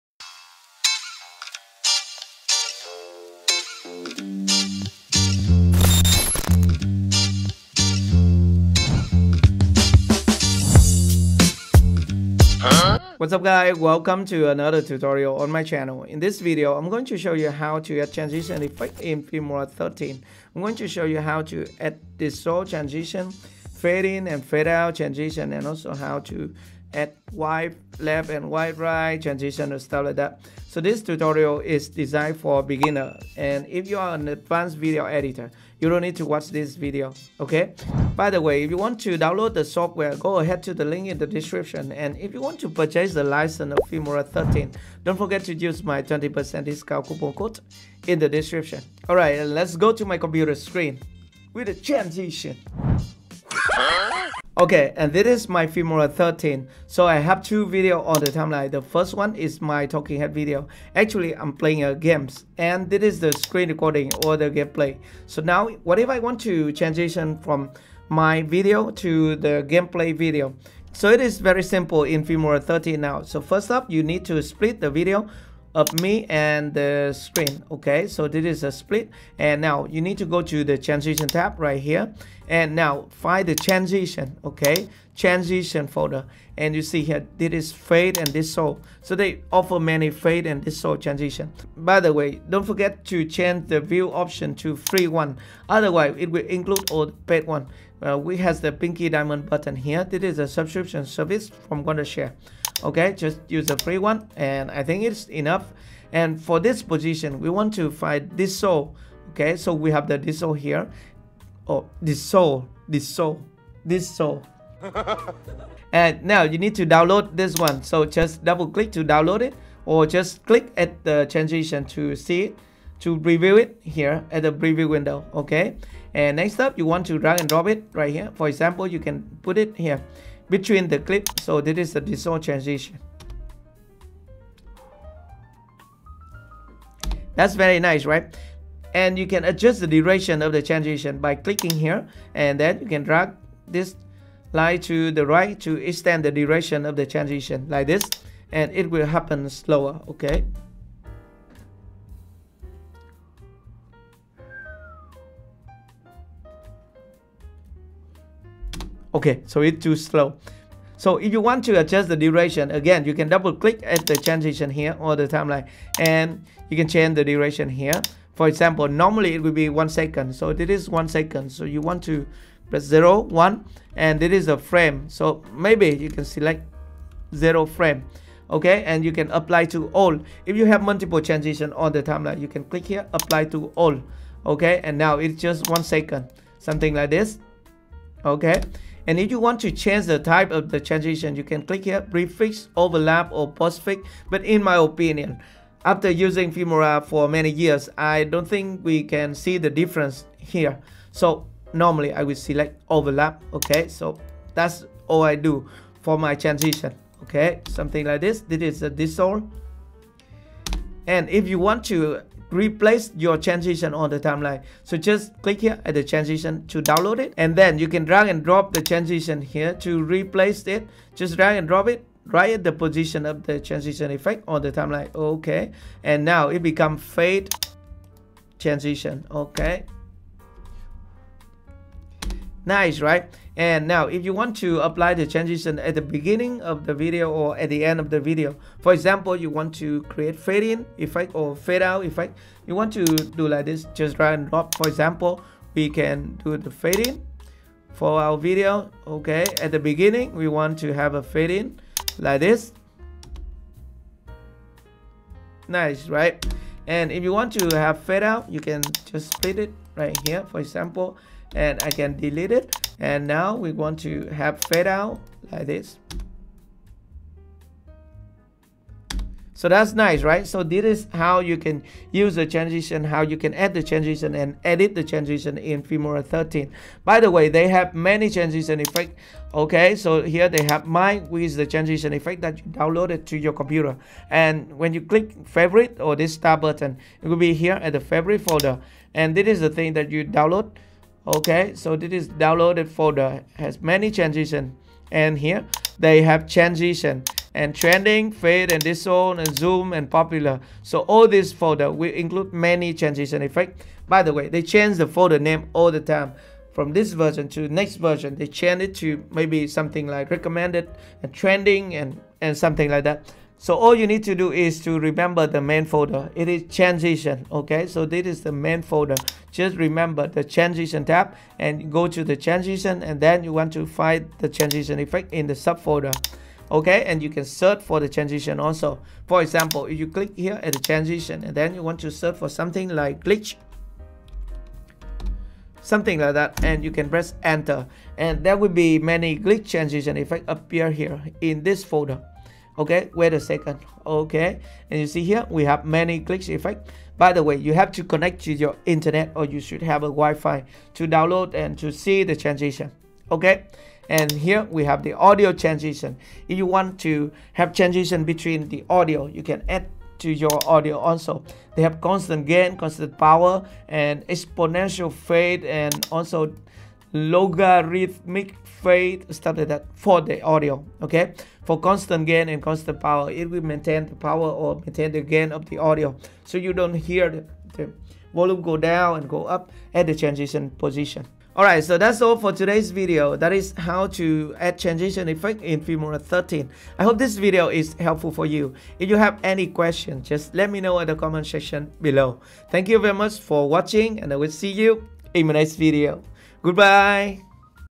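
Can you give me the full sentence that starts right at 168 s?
For example, normally it will be one second.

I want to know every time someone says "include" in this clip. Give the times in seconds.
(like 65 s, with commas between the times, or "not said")
96 s, 302 s.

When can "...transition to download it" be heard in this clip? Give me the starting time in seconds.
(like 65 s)
216 s.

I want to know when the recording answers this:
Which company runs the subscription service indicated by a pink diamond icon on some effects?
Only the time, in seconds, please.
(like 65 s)
101 s.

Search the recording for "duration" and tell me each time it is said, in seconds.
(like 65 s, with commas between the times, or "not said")
139 s, 146 s, 162 s, 167 s.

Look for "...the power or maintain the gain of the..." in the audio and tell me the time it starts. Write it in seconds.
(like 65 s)
374 s.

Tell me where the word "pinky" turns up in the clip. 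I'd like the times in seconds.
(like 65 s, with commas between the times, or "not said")
98 s.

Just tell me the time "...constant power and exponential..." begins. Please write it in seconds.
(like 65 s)
362 s.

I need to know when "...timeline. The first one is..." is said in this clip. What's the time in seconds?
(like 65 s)
58 s.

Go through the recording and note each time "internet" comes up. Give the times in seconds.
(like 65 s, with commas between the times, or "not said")
348 s.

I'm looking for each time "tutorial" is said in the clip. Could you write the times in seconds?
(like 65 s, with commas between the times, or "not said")
14 s, 31 s.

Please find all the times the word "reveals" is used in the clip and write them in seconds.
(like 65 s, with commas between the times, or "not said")
not said.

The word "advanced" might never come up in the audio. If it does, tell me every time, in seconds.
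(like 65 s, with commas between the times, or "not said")
34 s.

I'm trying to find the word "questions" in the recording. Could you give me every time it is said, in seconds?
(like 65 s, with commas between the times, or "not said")
389 s.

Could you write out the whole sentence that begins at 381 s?
Alright, so that's all for today's video.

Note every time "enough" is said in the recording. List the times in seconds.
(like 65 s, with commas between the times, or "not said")
105 s.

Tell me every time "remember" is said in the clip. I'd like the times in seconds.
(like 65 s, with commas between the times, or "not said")
314 s, 319 s.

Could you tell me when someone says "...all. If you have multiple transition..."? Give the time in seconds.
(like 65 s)
179 s.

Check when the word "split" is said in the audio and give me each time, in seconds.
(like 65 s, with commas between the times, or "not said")
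74 s, 78 s, 259 s.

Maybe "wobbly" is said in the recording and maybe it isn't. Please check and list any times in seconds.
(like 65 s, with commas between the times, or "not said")
not said.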